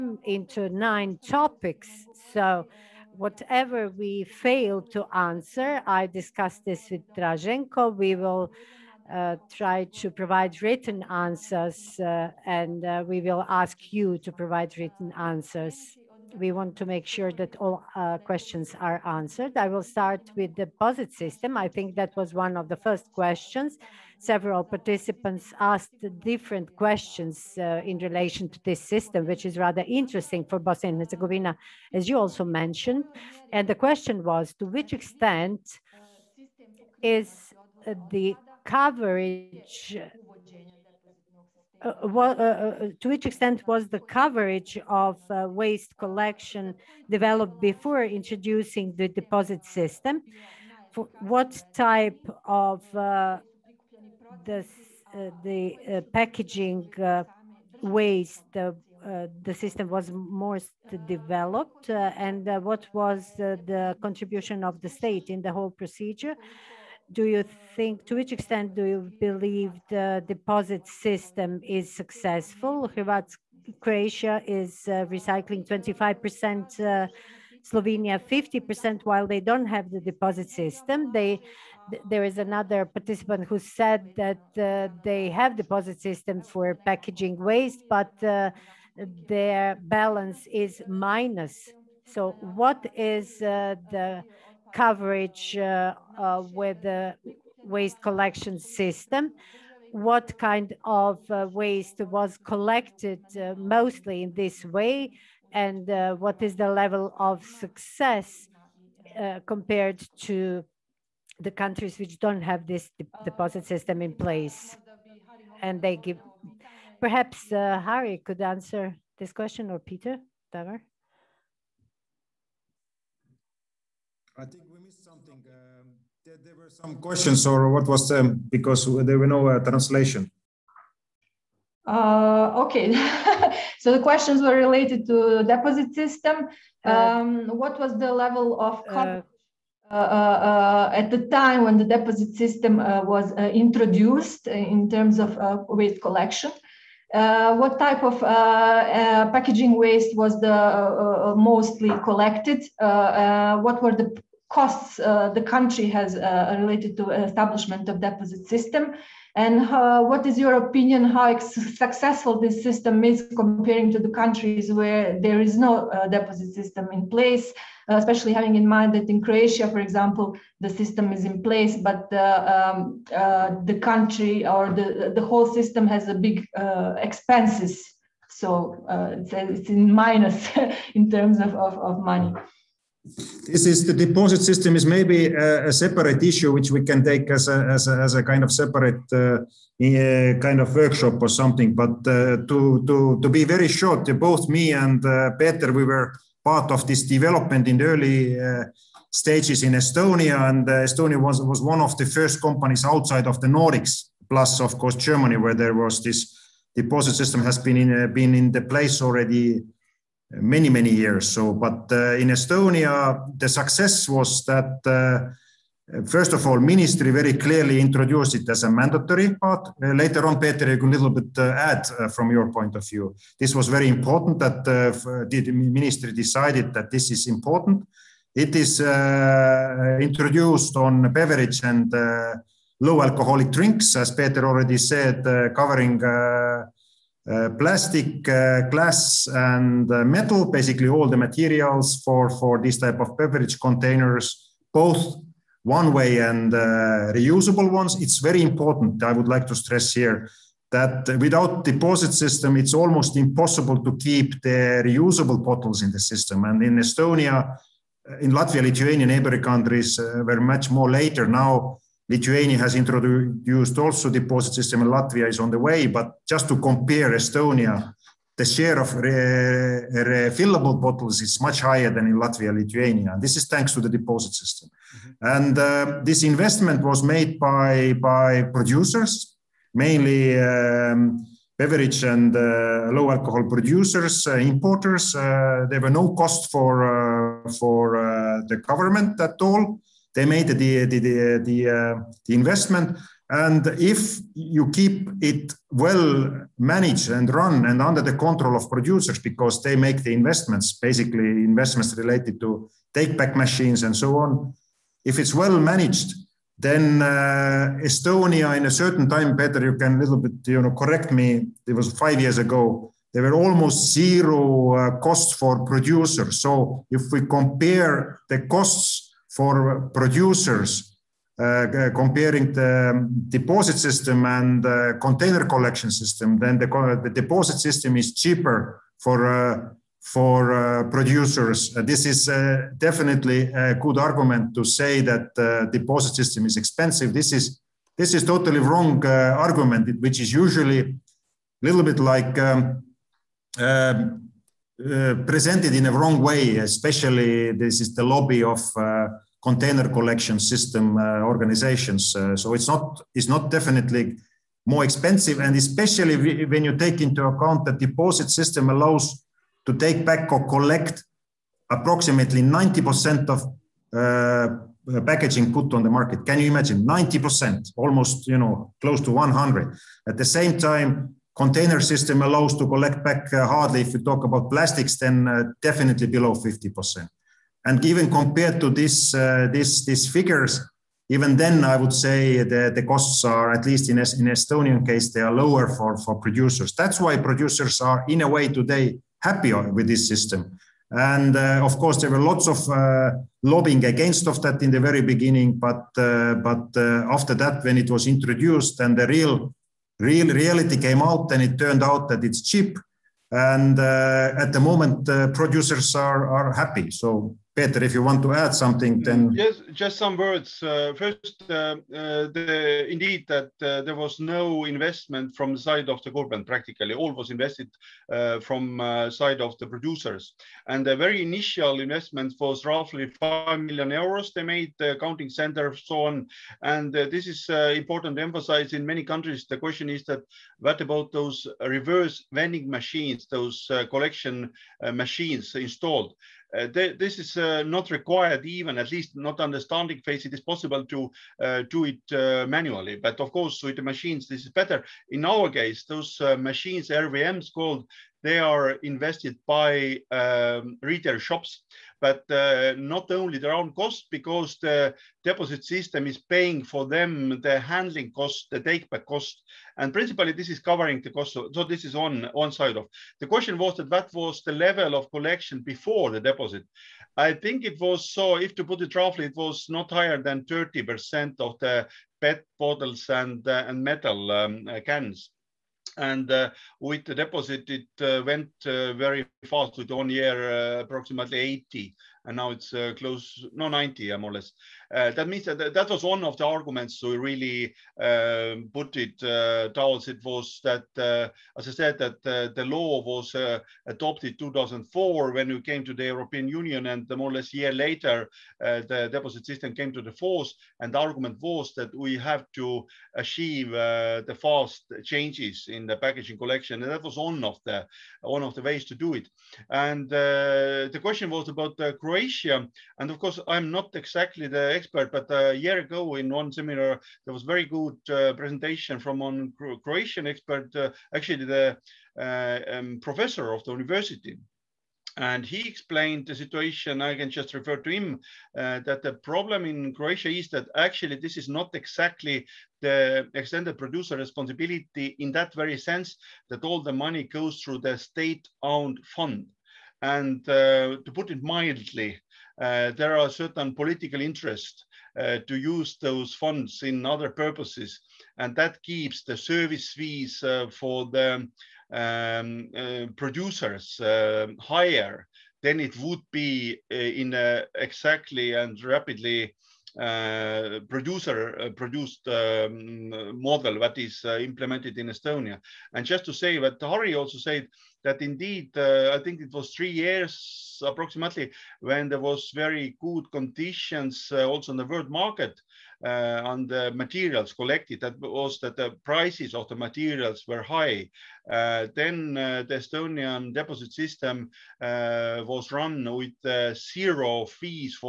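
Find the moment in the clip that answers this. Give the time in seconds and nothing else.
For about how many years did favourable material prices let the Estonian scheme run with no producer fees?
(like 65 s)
569 s.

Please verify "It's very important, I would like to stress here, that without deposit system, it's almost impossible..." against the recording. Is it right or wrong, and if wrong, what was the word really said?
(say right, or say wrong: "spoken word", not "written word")
right.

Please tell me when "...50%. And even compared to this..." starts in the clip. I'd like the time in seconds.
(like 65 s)
376 s.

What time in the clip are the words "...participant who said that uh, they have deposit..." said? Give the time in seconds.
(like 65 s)
82 s.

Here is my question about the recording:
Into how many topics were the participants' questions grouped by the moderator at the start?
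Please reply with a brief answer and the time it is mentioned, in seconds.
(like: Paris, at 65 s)
9, at 0 s.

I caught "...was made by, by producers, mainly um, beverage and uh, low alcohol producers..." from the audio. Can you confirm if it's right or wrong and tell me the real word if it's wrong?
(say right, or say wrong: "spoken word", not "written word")
right.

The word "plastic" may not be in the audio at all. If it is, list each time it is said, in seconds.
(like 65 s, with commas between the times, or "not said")
237 s, 374 s.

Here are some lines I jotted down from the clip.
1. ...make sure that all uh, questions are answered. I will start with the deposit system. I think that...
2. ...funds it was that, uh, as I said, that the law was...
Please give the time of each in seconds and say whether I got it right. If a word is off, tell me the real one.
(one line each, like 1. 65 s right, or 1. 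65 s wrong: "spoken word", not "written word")
1. 16 s right
2. 489 s wrong: "towards", not "funds".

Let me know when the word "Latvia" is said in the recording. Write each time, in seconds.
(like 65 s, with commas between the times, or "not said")
258 s, 264 s, 272 s.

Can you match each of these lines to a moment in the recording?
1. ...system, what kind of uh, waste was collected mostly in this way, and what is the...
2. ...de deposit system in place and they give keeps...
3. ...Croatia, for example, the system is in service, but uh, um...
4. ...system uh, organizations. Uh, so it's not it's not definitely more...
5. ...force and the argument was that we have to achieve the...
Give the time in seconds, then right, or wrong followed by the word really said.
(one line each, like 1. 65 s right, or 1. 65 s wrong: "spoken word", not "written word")
1. 98 s right
2. 112 s wrong: "perhaps", not "keeps"
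3. 169 s wrong: "place", not "service"
4. 350 s right
5. 500 s right.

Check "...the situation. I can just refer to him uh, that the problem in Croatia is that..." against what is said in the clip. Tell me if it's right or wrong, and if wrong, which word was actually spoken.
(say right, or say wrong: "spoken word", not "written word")
right.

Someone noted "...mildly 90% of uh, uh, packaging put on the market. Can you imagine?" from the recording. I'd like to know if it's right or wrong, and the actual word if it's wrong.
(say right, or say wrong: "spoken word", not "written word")
wrong: "approximately", not "mildly".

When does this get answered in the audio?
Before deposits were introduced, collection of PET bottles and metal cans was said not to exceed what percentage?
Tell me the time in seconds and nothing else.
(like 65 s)
470 s.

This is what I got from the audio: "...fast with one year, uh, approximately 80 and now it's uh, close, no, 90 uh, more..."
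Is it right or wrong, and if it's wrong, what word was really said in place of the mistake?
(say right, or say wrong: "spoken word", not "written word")
right.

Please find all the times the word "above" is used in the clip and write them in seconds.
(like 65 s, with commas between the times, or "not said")
not said.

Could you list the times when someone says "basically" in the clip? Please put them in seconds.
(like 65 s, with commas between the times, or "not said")
240 s, 300 s.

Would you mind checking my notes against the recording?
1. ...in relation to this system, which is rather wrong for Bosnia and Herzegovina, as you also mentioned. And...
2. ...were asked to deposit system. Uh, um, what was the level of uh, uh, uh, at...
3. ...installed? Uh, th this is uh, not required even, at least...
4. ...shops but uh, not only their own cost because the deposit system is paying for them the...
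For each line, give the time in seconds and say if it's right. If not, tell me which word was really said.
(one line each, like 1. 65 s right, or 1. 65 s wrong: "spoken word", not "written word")
1. 27 s wrong: "interesting", not "wrong"
2. 134 s wrong: "related", not "asked"
3. 435 s right
4. 451 s right.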